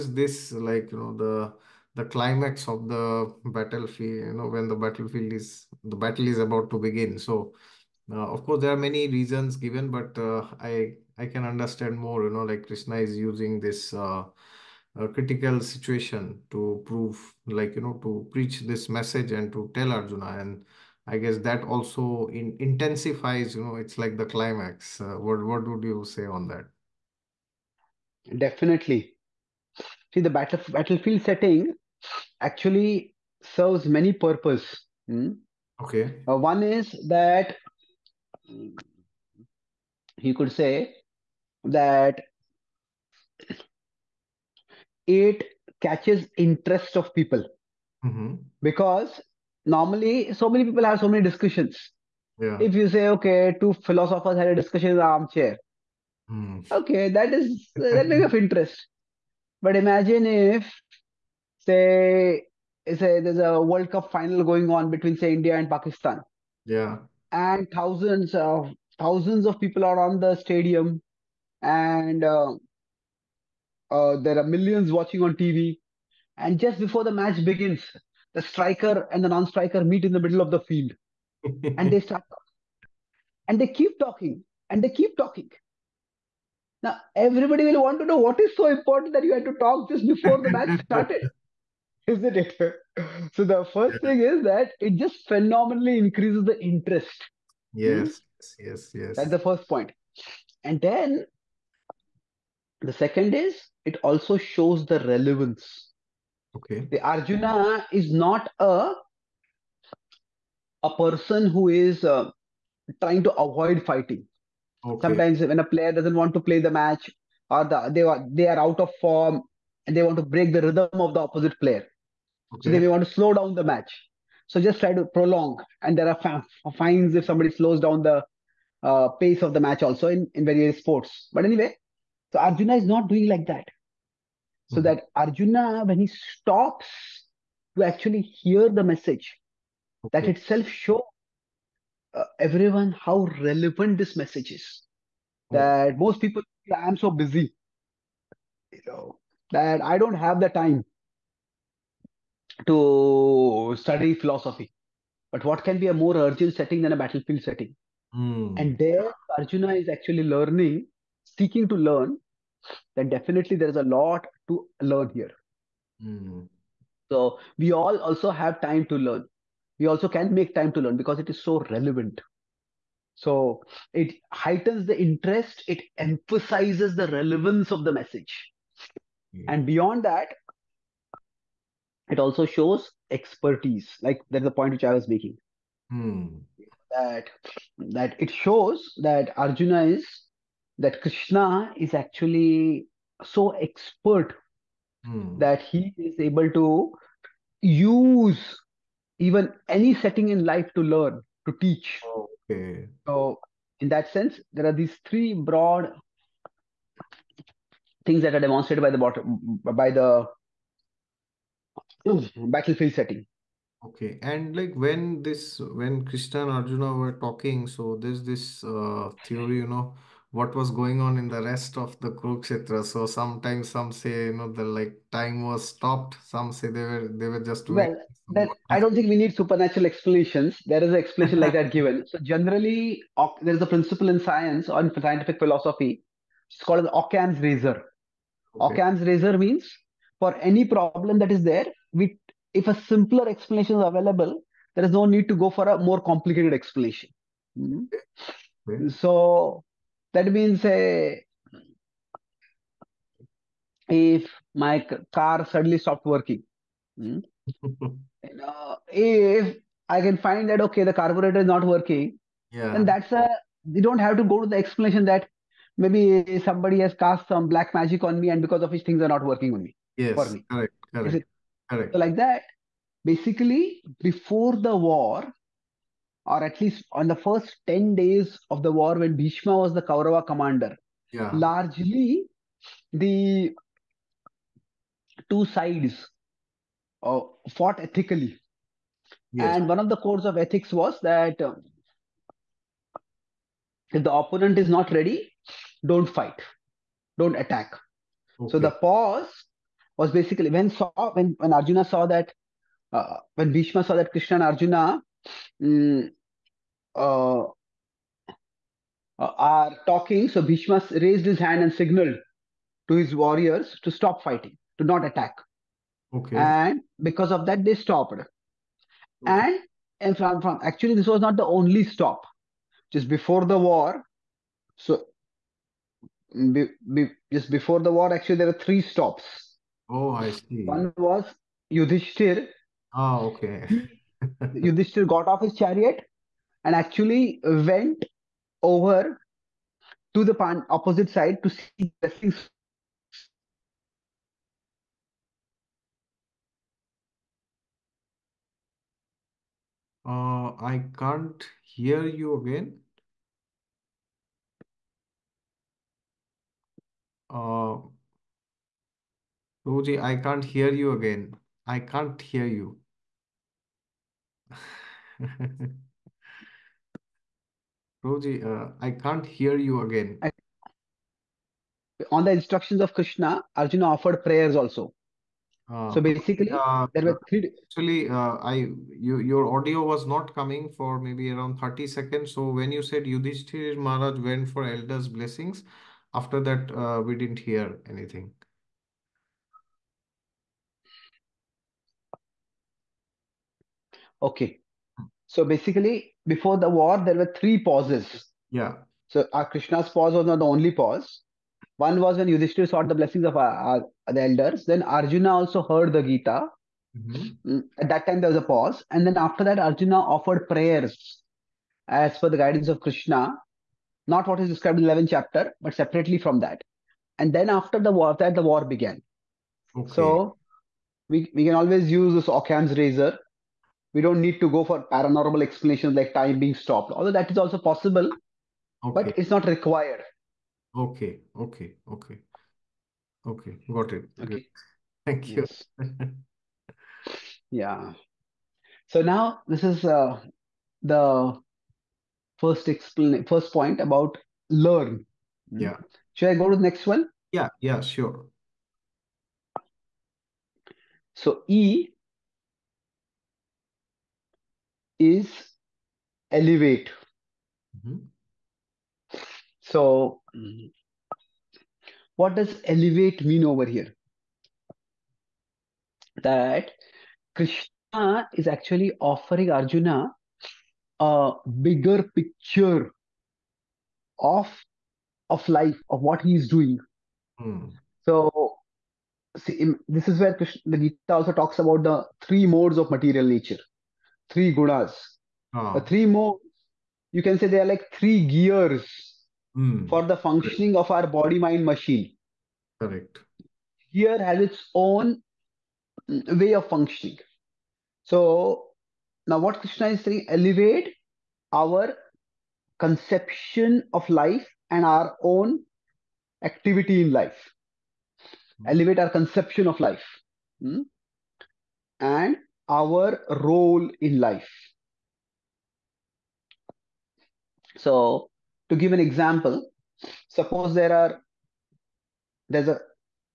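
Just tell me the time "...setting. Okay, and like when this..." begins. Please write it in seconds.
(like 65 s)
212 s.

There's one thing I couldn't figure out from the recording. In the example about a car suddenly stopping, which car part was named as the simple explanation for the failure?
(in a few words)
carburetor.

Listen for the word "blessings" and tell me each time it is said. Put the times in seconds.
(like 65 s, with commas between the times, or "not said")
385 s, 402 s.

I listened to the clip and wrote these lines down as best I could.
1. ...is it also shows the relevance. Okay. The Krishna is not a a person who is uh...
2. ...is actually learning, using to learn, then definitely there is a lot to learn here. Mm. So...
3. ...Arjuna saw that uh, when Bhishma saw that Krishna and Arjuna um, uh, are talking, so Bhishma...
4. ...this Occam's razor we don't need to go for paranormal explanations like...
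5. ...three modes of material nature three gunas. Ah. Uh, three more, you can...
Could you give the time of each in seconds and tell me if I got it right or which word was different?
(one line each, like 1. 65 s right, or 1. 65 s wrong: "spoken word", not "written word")
1. 103 s wrong: "Arjuna", not "Krishna"
2. 159 s wrong: "seeking", not "using"
3. 301 s right
4. 422 s right
5. 482 s right.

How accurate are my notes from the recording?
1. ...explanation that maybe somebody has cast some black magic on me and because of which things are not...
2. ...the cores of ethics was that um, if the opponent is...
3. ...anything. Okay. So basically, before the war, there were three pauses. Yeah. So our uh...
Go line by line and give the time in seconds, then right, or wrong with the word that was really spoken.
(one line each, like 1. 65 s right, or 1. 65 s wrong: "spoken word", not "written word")
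1. 264 s right
2. 289 s right
3. 387 s right.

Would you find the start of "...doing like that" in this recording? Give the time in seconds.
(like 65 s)
133 s.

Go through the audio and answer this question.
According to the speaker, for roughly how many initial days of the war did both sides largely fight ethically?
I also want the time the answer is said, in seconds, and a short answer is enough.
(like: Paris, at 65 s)
10, at 277 s.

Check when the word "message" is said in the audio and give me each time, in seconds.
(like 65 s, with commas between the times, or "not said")
18 s, 138 s, 144 s, 177 s.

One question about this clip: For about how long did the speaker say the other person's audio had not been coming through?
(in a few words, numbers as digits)
30 seconds.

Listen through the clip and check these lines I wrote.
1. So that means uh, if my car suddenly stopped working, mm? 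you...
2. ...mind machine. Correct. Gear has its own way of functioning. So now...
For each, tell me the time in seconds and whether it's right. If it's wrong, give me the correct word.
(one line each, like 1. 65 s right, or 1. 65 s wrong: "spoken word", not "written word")
1. 248 s right
2. 491 s right.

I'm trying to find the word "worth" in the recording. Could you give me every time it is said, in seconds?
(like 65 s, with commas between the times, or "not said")
not said.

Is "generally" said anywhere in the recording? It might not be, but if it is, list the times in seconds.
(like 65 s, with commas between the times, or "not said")
232 s.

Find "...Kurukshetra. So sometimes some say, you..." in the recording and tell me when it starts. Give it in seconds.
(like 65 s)
222 s.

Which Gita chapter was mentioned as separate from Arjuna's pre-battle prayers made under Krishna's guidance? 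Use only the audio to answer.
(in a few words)
11th chapter.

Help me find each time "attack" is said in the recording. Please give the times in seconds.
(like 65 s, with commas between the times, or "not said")
297 s, 315 s.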